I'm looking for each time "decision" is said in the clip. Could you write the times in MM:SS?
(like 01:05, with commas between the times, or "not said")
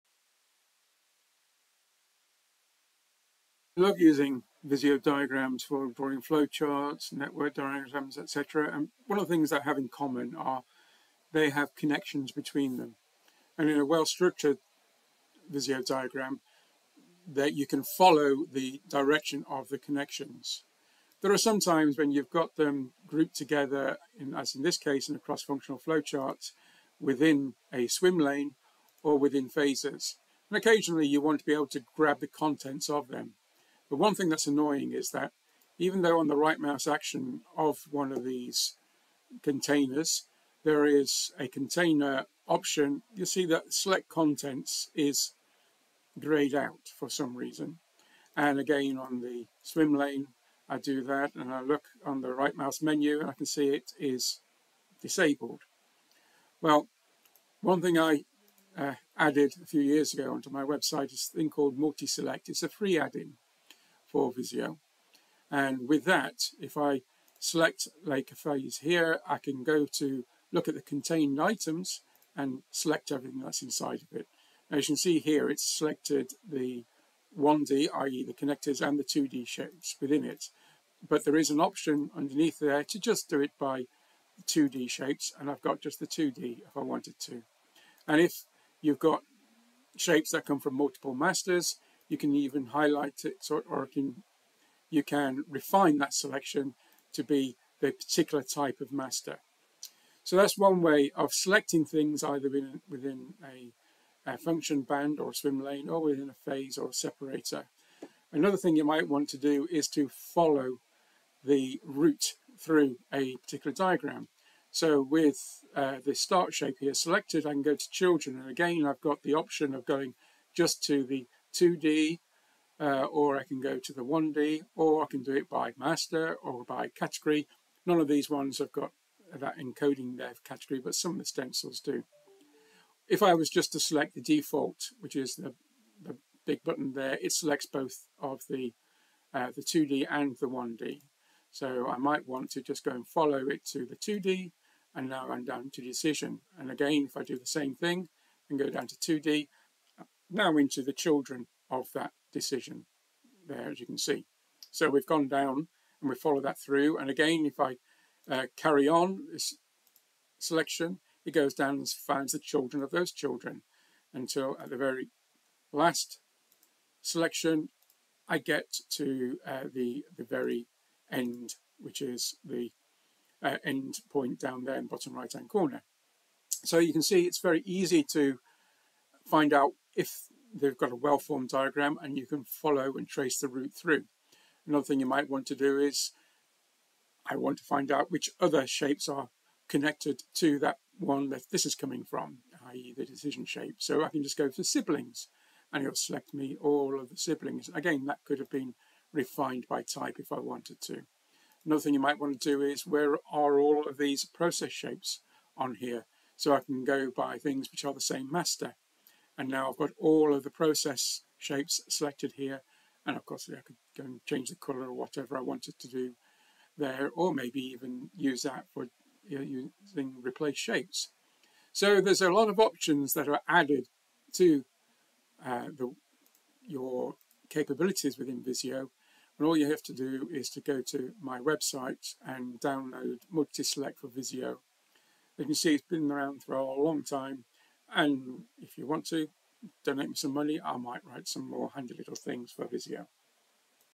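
02:25, 02:32, 03:13.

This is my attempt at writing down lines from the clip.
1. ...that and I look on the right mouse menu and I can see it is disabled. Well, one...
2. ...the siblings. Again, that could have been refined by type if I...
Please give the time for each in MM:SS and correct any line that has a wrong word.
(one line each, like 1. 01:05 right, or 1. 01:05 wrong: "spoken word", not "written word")
1. 00:51 right
2. 03:17 right.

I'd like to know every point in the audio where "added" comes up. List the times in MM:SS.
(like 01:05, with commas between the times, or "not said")
00:59, 03:43.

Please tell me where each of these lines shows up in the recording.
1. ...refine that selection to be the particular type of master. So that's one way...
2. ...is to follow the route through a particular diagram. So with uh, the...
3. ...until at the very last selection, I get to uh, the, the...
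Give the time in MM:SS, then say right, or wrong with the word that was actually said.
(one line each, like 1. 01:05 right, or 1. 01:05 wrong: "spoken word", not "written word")
1. 01:35 right
2. 01:49 right
3. 02:44 right.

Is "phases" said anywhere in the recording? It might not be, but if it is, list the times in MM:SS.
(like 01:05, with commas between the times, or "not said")
00:29, 01:08, 01:46.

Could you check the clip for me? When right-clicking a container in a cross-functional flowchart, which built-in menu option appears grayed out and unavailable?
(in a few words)
Select contents.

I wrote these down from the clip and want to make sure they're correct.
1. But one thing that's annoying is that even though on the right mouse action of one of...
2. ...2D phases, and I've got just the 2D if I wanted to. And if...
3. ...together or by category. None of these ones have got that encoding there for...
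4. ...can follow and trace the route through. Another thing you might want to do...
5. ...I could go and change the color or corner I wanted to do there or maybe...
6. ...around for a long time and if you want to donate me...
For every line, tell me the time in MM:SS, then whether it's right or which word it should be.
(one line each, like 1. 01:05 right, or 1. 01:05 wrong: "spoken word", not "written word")
1. 00:33 right
2. 01:24 wrong: "shapes", not "phases"
3. 02:05 wrong: "master", not "together"
4. 03:02 right
5. 03:33 wrong: "whatever", not "corner"
6. 03:56 right.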